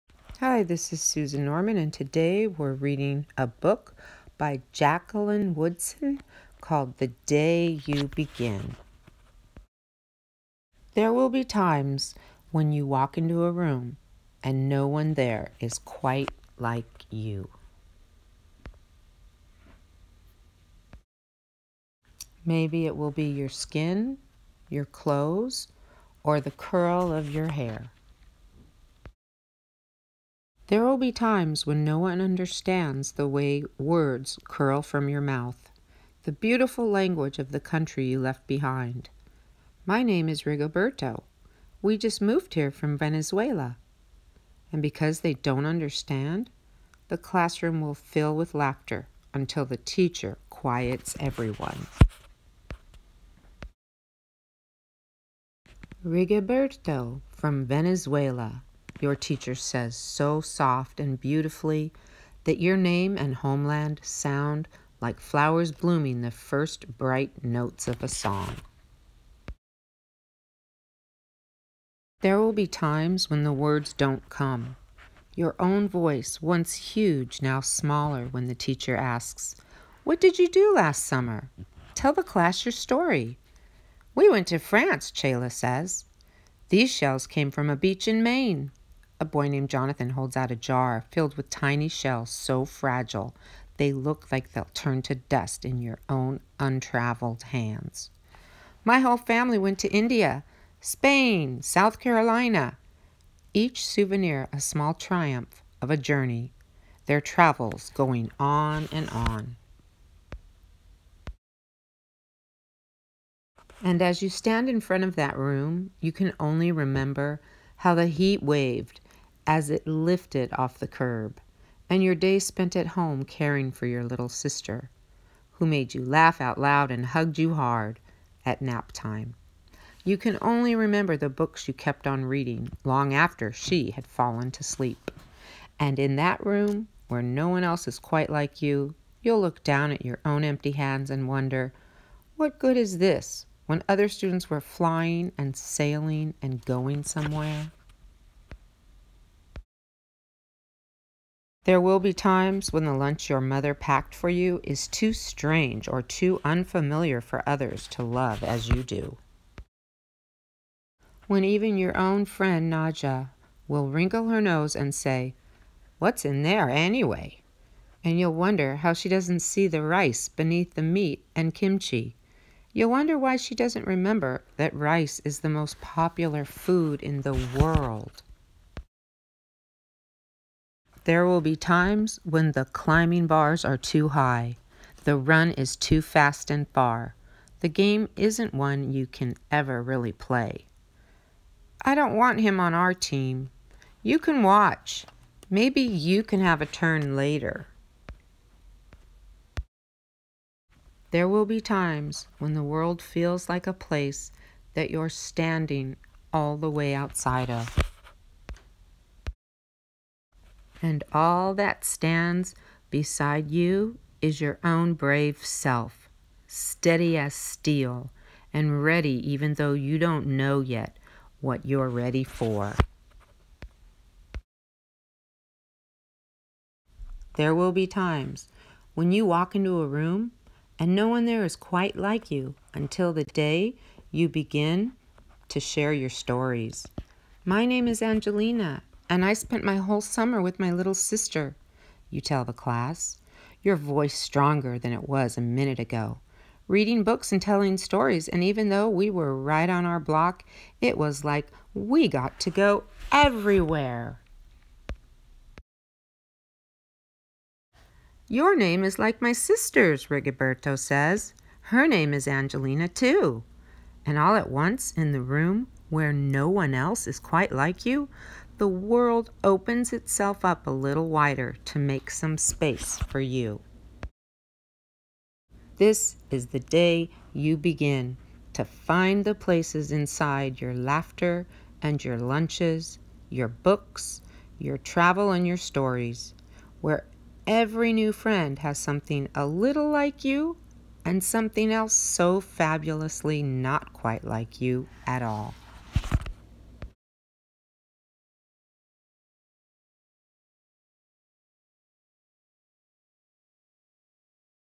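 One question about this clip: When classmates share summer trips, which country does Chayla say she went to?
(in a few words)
France.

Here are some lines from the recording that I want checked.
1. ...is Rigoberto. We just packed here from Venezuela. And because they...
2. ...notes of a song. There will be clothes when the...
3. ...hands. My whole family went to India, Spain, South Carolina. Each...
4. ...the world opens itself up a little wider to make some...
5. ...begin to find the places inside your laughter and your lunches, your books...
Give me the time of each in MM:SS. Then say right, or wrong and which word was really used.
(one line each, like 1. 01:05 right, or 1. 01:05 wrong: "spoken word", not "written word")
1. 00:40 wrong: "moved", not "packed"
2. 01:07 wrong: "times", not "clothes"
3. 01:37 right
4. 04:28 right
5. 04:37 right.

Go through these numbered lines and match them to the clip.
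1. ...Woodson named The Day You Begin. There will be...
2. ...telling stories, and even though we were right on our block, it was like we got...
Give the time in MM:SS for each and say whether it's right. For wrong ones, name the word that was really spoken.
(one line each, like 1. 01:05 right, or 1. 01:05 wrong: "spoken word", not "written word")
1. 00:05 wrong: "called", not "named"
2. 04:07 right.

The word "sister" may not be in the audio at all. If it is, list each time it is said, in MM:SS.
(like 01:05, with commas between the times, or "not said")
02:04, 04:00, 04:19.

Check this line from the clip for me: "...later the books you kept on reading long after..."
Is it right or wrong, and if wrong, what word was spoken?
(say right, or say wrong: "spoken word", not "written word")
wrong: "remember", not "later".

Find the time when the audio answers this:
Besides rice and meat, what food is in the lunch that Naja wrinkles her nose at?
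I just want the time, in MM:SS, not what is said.
02:51.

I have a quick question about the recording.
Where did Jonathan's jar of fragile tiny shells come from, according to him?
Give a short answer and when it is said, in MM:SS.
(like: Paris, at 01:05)
Maine, at 01:28.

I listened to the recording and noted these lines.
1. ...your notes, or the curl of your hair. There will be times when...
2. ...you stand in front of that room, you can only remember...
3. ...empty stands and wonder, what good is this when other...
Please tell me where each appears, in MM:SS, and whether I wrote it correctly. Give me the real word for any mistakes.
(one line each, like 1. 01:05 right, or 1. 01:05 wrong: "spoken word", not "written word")
1. 00:24 wrong: "clothes", not "notes"
2. 01:54 right
3. 02:20 wrong: "hands", not "stands".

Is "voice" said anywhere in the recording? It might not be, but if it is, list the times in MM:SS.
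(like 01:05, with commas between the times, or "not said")
01:15, 04:03.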